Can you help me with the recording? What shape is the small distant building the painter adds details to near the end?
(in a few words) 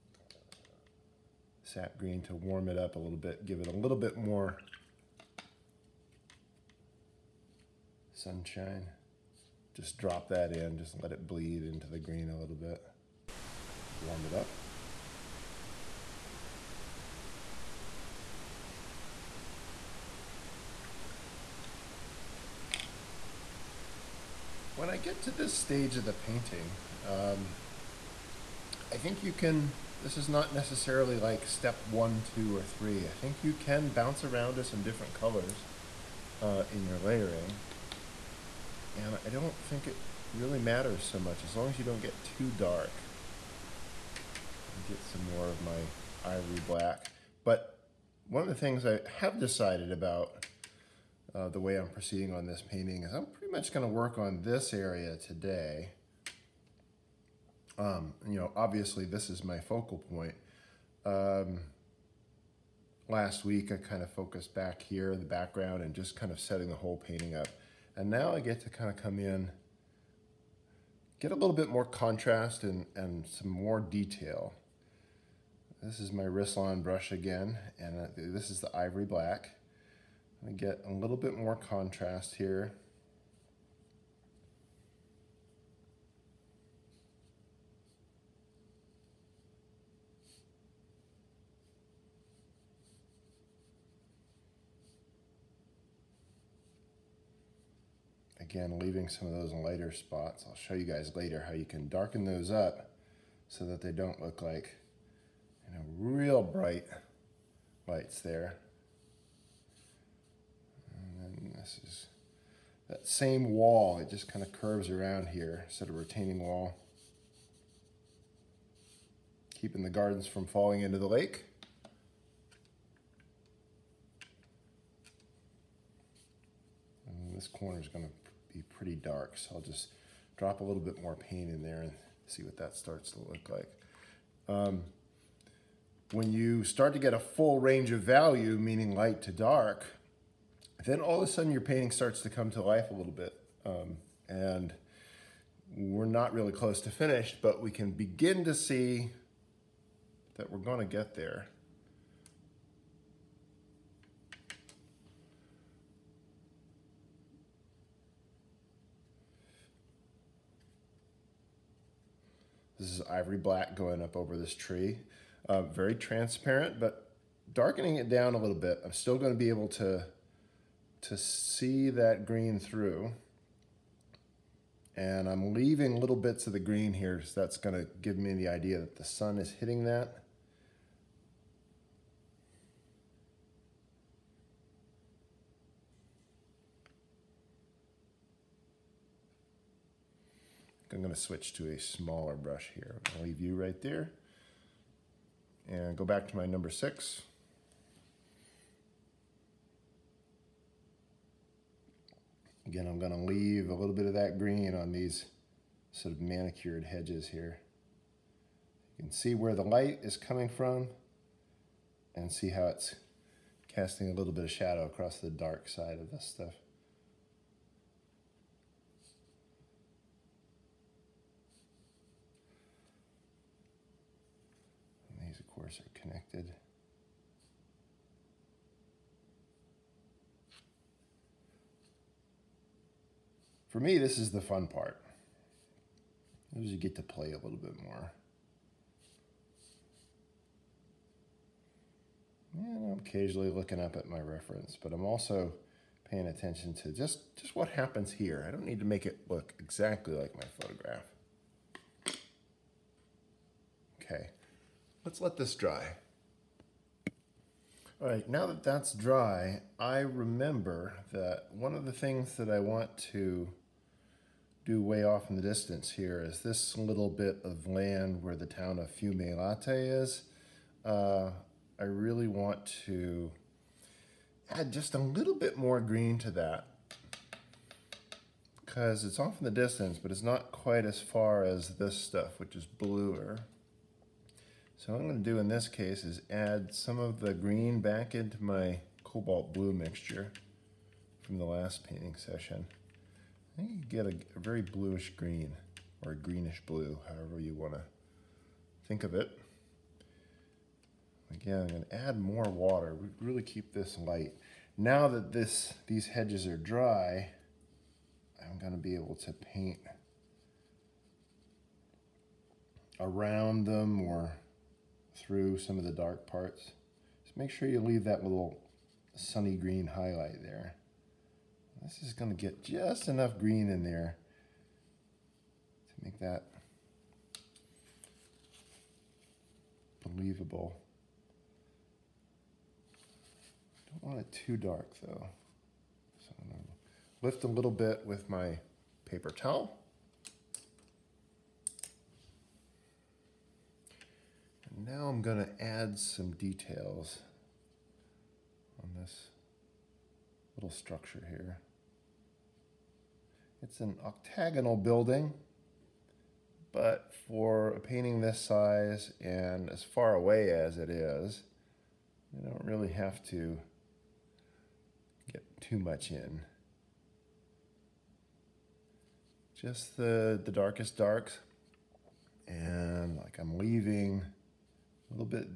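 Octagonal.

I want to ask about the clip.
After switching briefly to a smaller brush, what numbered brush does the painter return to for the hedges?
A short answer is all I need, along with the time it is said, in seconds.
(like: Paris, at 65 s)
Number 6, at 196 s.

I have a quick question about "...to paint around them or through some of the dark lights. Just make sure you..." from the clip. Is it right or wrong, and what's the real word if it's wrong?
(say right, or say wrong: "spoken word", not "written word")
wrong: "parts", not "lights".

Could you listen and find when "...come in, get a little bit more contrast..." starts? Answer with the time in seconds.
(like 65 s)
68 s.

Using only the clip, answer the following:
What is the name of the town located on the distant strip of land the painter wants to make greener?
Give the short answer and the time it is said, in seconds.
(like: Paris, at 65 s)
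Fiume Latte, at 268 s.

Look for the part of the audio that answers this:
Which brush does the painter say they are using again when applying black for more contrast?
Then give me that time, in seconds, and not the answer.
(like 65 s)
76 s.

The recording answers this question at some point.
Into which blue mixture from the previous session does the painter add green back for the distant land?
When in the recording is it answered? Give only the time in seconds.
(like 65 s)
289 s.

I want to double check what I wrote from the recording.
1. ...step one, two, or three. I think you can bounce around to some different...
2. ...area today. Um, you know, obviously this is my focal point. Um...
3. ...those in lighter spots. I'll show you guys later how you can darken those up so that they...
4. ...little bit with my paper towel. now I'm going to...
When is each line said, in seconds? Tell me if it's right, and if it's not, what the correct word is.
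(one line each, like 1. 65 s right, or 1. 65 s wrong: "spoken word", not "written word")
1. 31 s right
2. 54 s right
3. 99 s right
4. 337 s right.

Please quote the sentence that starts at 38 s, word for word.
And I don't think it really matters so much as long as you don't get too dark.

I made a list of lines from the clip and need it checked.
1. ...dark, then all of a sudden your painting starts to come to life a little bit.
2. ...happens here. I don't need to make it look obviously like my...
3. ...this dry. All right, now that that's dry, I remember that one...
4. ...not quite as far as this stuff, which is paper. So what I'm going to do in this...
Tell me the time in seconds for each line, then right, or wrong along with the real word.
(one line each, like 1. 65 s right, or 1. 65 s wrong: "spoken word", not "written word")
1. 139 s right
2. 247 s wrong: "exactly", not "obviously"
3. 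255 s right
4. 280 s wrong: "bluer", not "paper".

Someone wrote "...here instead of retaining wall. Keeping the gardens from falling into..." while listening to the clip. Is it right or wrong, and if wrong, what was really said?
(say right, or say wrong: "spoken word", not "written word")
right.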